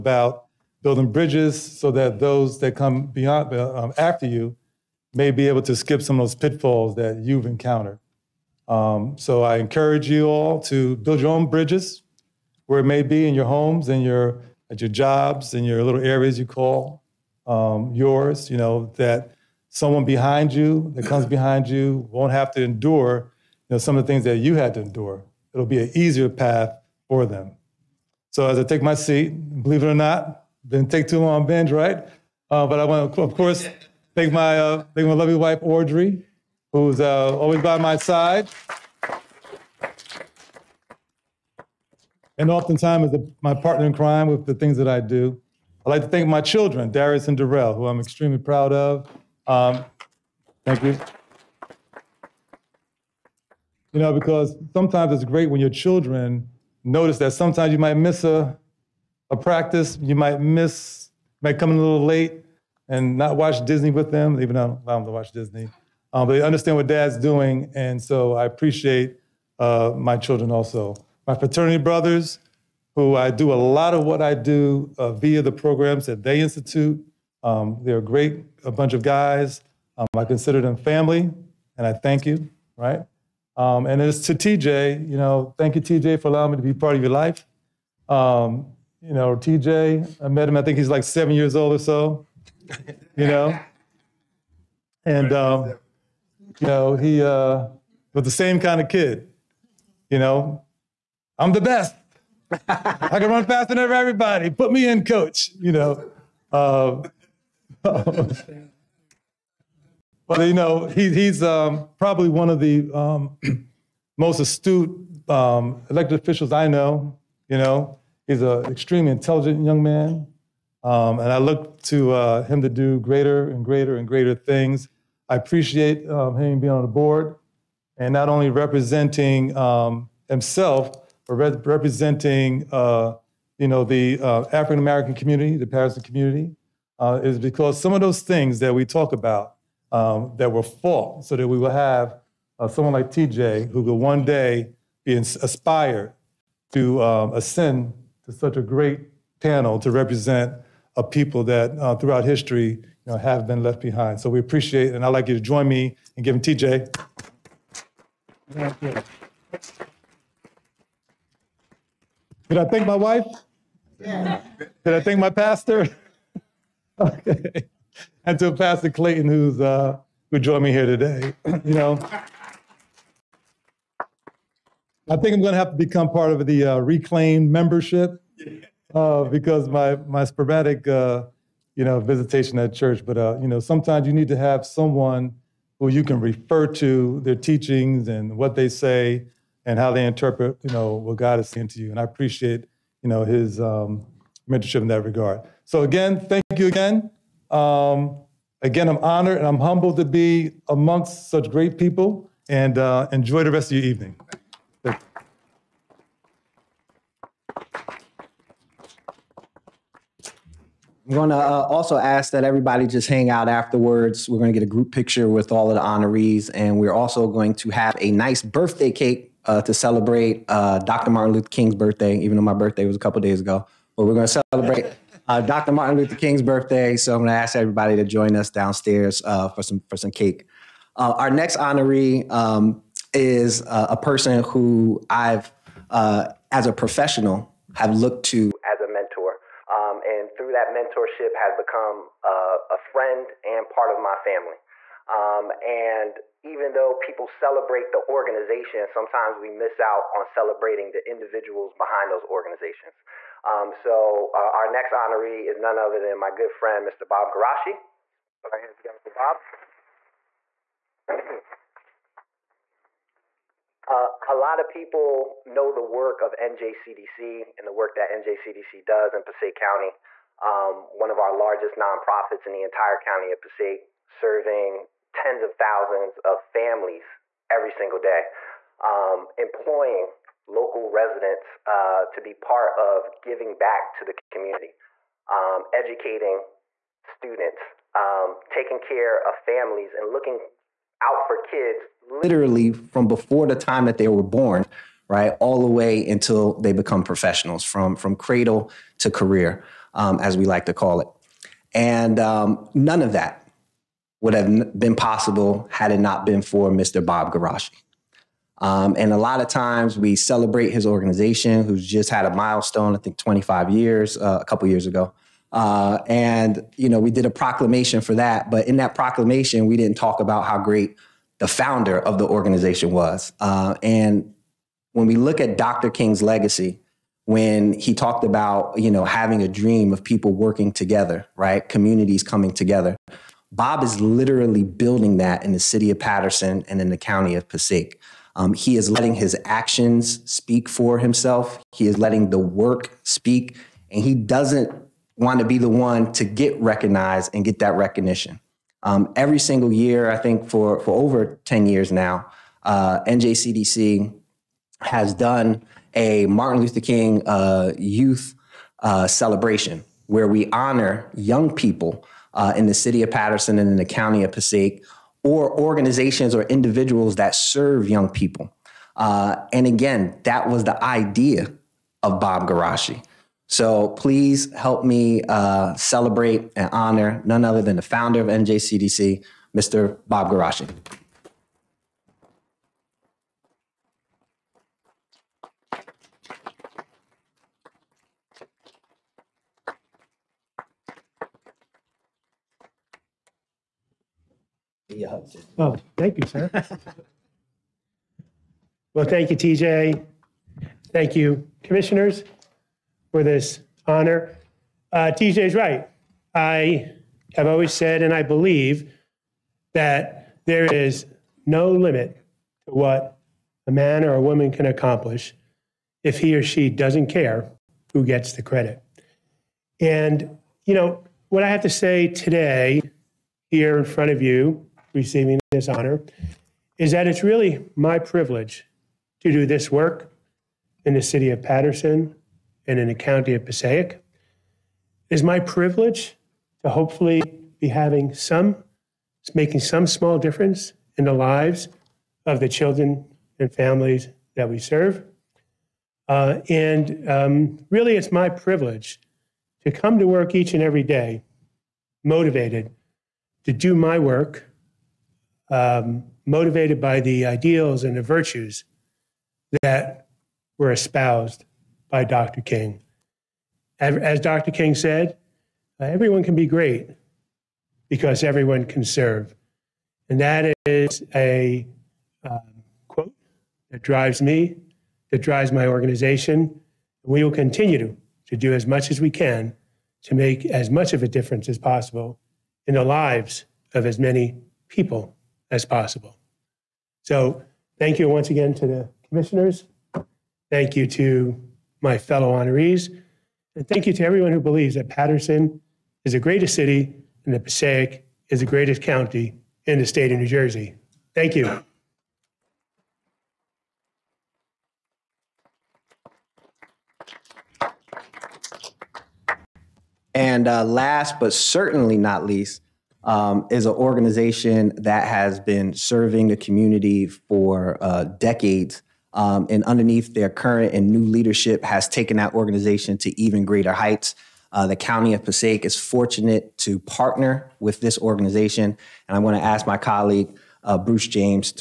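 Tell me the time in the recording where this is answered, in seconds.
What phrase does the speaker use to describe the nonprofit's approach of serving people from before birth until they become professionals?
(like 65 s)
298 s.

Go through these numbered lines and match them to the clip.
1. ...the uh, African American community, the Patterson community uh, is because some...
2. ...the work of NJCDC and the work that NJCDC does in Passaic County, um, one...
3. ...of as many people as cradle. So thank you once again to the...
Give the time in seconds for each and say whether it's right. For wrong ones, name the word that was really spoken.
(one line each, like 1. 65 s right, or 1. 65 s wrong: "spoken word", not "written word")
1. 133 s right
2. 265 s right
3. 483 s wrong: "possible", not "cradle".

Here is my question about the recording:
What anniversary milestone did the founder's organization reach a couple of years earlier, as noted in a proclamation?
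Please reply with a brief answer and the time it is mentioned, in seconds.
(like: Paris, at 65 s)
25 years, at 313 s.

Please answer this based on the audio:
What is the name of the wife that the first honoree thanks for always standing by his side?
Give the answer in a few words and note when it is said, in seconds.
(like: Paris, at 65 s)
Audrey, at 35 s.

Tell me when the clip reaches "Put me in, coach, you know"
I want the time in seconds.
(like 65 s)
104 s.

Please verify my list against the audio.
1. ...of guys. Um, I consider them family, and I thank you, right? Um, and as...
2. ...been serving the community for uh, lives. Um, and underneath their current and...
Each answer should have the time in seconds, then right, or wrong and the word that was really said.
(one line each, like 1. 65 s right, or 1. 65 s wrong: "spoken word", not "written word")
1. 78 s right
2. 515 s wrong: "decades", not "lives".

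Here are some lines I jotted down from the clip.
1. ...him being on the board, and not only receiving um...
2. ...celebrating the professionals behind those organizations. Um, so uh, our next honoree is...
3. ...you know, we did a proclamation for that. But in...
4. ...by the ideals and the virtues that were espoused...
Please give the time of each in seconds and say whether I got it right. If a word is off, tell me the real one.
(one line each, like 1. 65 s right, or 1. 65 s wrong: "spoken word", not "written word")
1. 126 s wrong: "representing", not "receiving"
2. 250 s wrong: "individuals", not "professionals"
3. 316 s right
4. 456 s right.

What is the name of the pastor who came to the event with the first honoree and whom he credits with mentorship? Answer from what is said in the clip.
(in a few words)
Pastor Clayton.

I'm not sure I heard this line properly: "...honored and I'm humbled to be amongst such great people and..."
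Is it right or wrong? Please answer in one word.
right.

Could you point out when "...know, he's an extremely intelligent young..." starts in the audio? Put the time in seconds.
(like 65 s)
117 s.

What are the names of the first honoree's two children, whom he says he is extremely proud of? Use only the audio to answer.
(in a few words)
Darius and Darrell.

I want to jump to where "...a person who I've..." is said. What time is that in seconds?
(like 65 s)
233 s.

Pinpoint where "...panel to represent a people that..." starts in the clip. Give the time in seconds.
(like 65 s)
149 s.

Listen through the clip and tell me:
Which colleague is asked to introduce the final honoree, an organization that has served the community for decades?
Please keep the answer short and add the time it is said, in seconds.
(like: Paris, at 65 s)
Bruce James, at 530 s.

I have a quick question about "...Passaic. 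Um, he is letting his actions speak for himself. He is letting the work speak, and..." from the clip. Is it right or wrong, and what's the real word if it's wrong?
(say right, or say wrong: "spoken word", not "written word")
right.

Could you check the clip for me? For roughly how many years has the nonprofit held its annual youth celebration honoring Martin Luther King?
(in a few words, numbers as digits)
over 10 years.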